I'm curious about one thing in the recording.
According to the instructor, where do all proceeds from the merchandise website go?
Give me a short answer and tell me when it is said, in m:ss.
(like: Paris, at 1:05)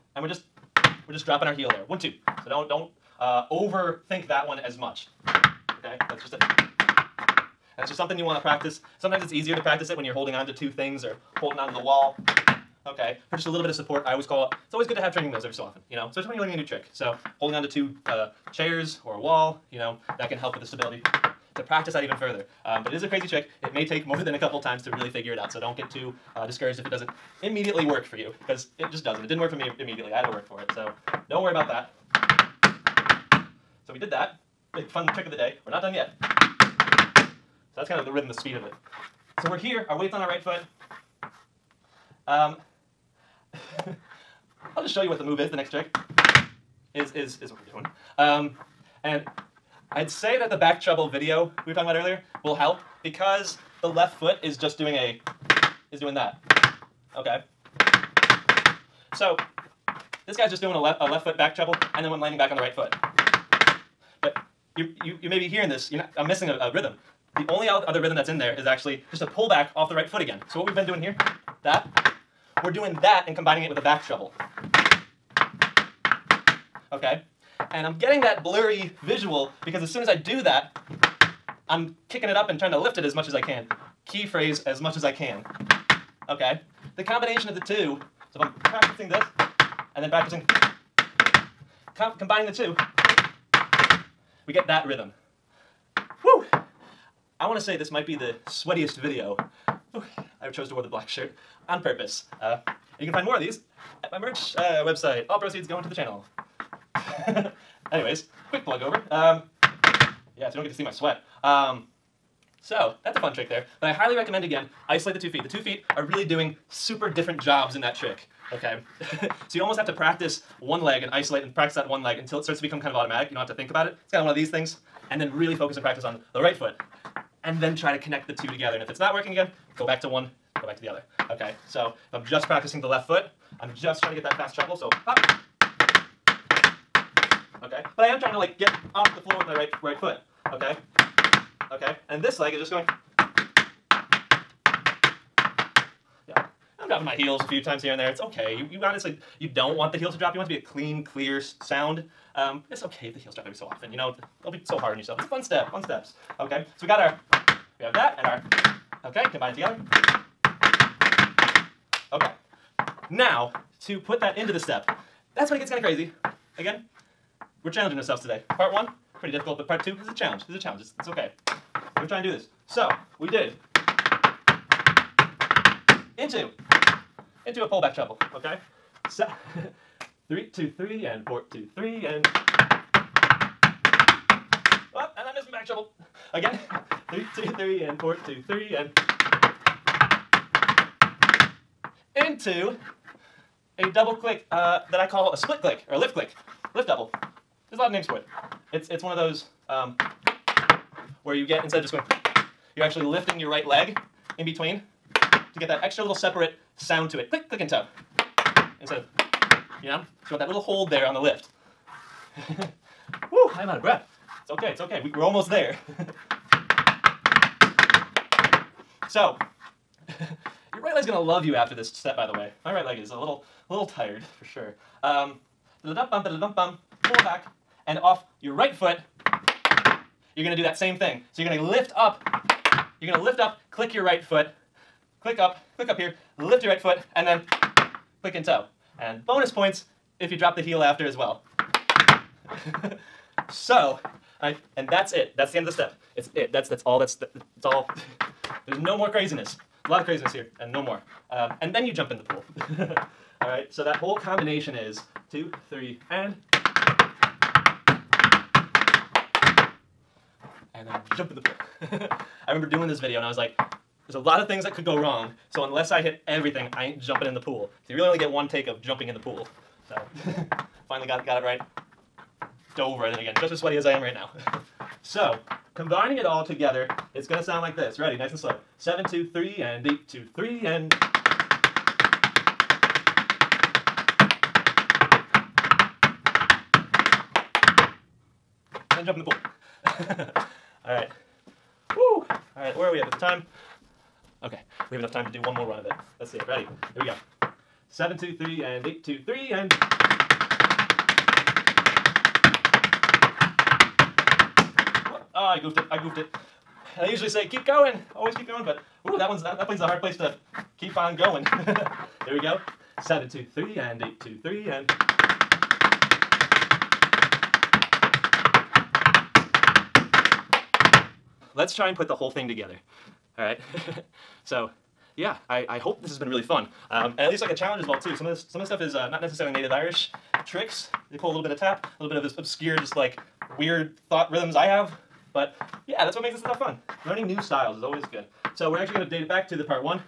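Into the channel, at 1:45.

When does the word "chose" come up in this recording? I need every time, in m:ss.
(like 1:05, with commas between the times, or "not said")
1:40.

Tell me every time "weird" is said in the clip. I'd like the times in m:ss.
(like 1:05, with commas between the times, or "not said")
5:33.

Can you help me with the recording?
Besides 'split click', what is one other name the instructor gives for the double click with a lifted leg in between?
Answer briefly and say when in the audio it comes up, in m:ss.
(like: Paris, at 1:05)
Lift click, at 3:15.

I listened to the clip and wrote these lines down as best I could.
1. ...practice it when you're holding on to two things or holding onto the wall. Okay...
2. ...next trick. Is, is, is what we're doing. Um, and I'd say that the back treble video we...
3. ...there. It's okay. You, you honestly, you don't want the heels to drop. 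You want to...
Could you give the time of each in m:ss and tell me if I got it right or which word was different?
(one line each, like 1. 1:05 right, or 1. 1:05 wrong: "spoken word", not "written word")
1. 0:09 right
2. 0:45 right
3. 2:27 right.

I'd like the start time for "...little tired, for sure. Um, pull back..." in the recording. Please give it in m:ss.
3:43.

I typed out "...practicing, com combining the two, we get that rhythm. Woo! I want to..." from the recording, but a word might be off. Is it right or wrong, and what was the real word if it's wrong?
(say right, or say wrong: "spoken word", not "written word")
right.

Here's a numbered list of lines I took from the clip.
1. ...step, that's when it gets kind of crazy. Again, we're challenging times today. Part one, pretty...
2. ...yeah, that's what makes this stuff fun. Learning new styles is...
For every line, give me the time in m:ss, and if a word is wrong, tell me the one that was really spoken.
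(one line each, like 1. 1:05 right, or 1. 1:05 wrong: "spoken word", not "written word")
1. 2:44 wrong: "ourselves", not "times"
2. 5:35 right.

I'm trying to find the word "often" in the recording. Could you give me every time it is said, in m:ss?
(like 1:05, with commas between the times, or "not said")
0:15, 2:33.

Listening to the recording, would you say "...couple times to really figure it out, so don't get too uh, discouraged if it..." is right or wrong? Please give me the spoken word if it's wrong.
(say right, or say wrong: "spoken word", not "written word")
right.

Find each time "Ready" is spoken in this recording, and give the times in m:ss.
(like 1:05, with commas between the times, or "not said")
4:37, 4:56.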